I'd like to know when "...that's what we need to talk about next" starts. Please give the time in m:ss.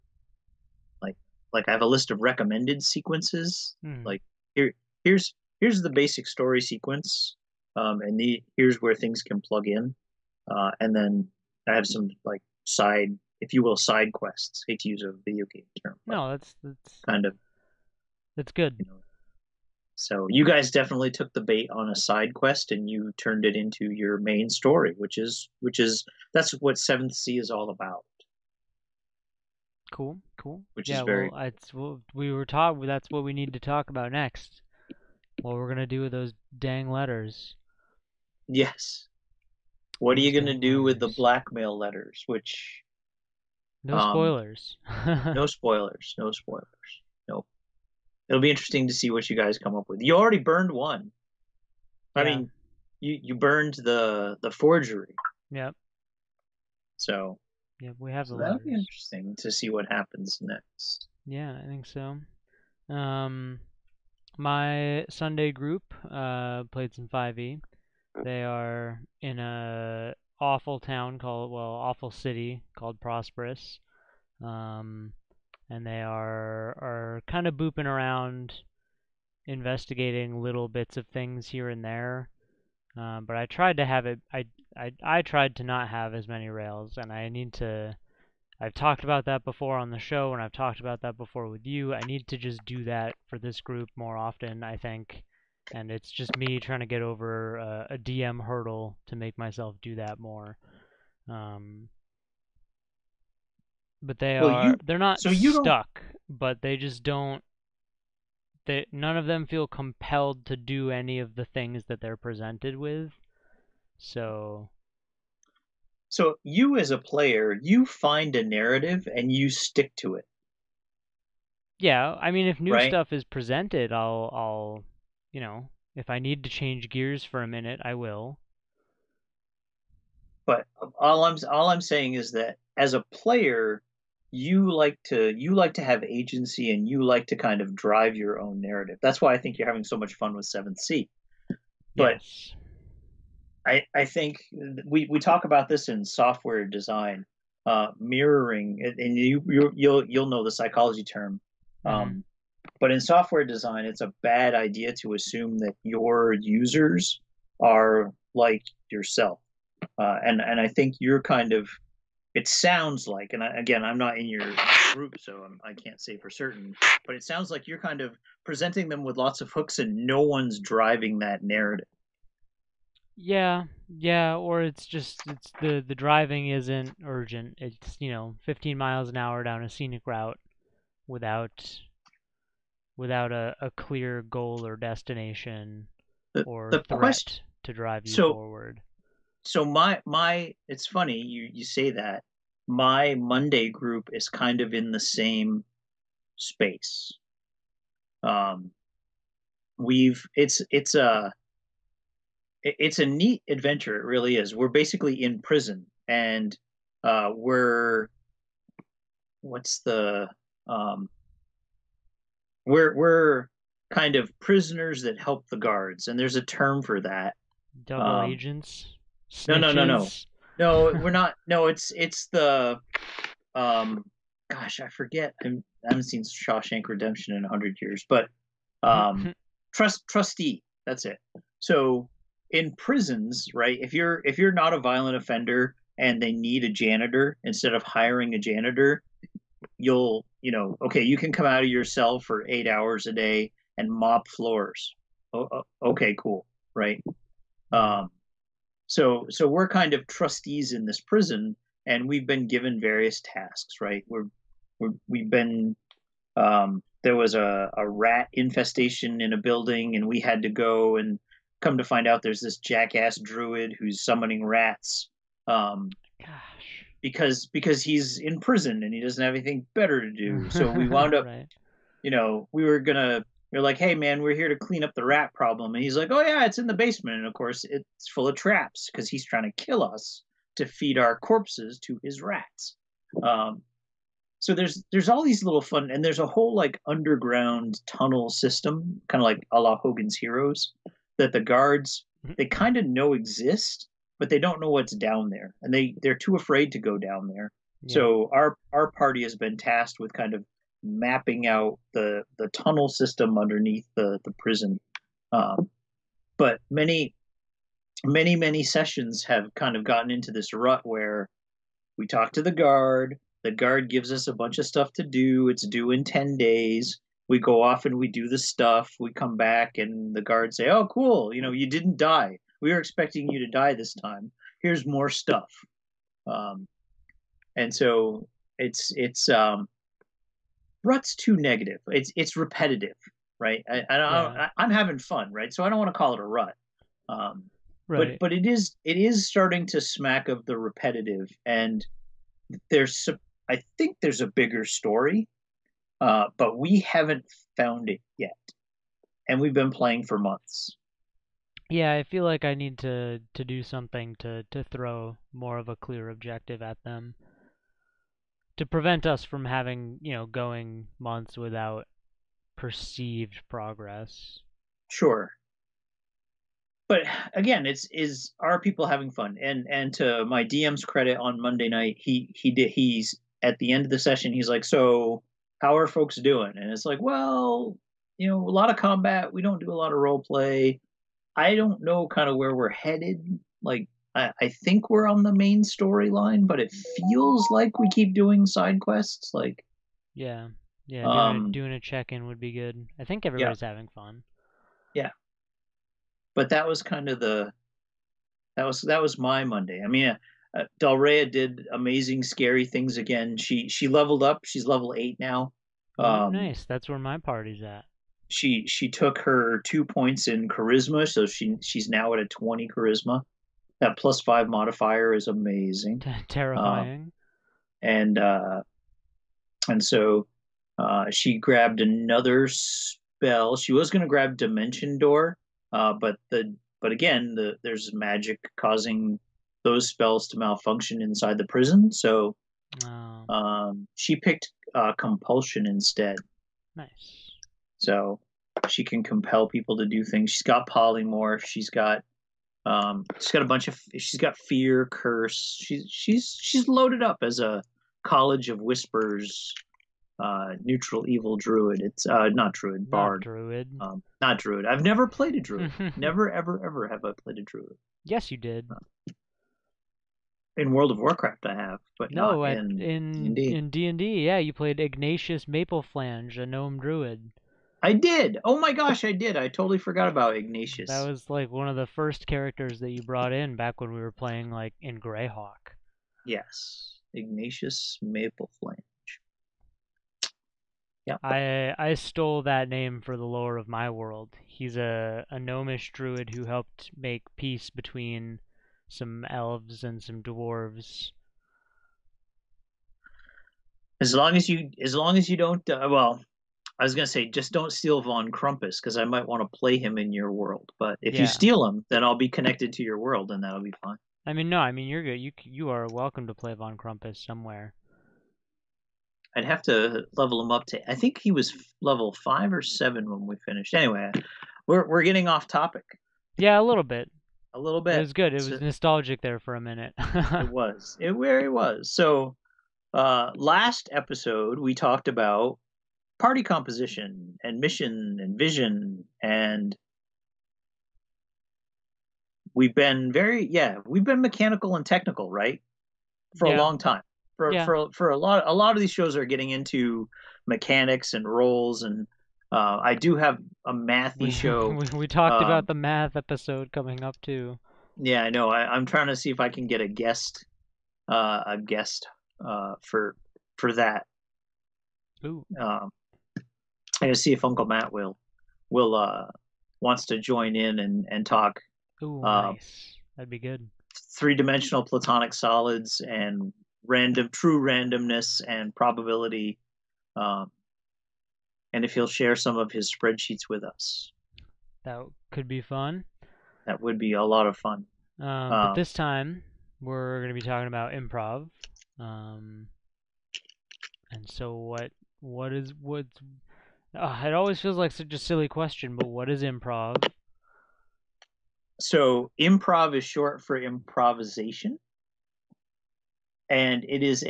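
0:32.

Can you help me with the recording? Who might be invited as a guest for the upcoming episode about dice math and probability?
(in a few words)
Uncle Matt.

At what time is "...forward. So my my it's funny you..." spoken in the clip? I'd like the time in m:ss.
3:08.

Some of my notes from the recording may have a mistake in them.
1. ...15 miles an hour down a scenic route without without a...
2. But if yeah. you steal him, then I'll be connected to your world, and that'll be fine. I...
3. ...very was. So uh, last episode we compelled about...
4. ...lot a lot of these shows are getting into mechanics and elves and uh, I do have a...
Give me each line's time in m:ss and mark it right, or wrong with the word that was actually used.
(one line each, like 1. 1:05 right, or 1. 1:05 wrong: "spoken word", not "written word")
1. 2:58 right
2. 8:20 right
3. 8:41 wrong: "talked", not "compelled"
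4. 8:58 wrong: "roles", not "elves".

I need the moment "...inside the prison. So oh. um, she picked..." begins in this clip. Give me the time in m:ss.
7:11.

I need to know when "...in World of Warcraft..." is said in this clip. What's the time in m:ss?
7:40.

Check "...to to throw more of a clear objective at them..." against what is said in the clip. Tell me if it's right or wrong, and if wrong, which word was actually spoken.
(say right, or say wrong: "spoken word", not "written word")
right.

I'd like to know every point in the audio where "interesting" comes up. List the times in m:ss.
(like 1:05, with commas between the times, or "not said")
0:48, 0:58.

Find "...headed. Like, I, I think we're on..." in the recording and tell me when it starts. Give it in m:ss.
6:22.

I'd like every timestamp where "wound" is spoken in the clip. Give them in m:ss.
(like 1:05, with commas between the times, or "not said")
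4:30.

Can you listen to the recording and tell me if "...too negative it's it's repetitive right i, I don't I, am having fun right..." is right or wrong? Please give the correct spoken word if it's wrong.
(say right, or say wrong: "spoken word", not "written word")
right.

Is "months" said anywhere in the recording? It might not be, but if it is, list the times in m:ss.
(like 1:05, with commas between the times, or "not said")
5:50, 6:00.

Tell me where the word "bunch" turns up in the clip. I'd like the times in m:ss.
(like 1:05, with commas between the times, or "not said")
5:14, 7:23.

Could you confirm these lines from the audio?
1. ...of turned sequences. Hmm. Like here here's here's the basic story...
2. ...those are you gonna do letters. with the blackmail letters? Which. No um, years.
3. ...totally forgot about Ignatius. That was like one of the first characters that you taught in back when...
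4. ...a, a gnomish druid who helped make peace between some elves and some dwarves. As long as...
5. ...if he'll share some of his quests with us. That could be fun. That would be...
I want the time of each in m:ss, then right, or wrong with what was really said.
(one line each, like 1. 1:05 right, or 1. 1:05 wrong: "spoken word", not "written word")
1. 0:02 wrong: "recommended", not "turned"
2. 0:40 wrong: "spoilers", not "years"
3. 7:49 wrong: "brought", not "taught"
4. 8:04 right
5. 9:31 wrong: "spreadsheets", not "quests".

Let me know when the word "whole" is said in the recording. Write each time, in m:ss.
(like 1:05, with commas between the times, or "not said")
4:46.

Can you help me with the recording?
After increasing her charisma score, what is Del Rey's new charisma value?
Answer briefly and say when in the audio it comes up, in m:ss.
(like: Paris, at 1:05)
20, at 6:52.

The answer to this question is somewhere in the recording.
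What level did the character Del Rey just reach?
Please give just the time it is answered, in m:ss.
6:44.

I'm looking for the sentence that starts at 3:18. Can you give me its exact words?
Um we've it's it's a it's a neat adventure.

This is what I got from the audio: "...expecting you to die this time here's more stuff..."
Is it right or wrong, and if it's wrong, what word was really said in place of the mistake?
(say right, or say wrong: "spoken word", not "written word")
right.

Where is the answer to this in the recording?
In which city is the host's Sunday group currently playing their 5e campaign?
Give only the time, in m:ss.
1:13.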